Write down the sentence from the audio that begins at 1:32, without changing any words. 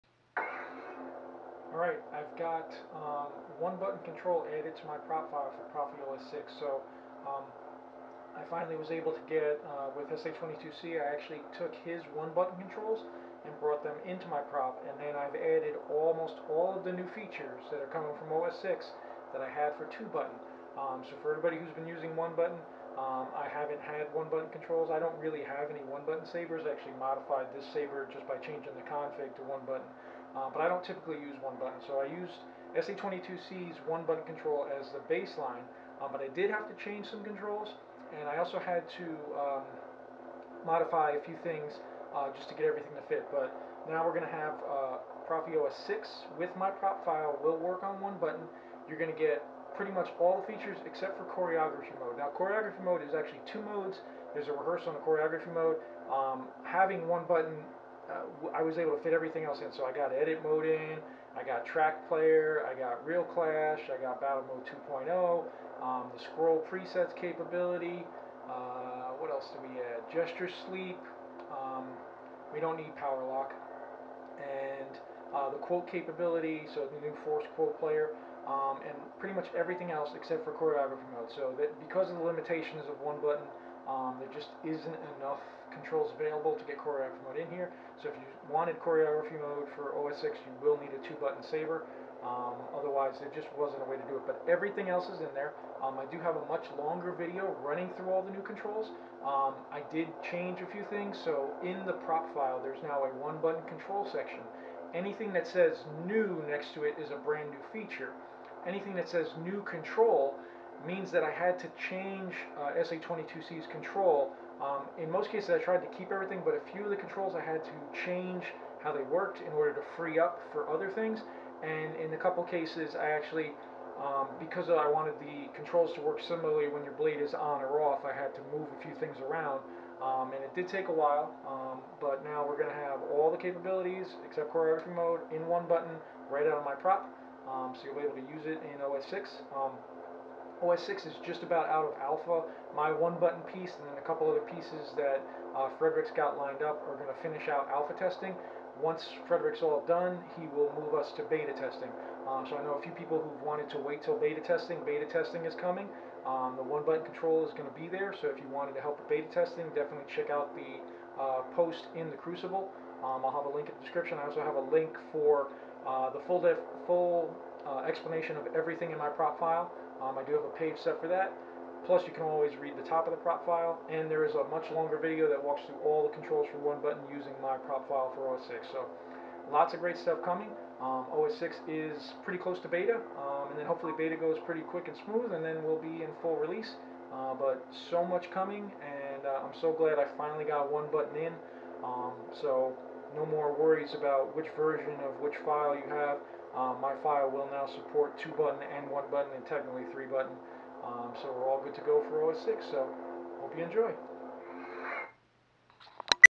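Um, otherwise, there just wasn't a way to do it.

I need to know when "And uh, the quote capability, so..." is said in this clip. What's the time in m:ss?
1:14.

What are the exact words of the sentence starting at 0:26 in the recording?
I actually modified this saber just by changing the config to one button.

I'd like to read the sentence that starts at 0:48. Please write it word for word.
You're going to get pretty much all the features except for choreography mode.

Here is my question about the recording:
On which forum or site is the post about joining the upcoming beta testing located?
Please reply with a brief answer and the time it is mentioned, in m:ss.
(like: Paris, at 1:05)
The Crucible, at 2:42.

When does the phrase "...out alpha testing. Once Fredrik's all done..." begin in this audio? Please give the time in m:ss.
2:27.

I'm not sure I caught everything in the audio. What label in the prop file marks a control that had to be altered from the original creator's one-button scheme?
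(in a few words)
New control.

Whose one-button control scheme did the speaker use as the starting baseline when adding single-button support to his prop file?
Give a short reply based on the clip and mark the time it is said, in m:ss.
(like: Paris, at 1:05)
SA22C, at 0:32.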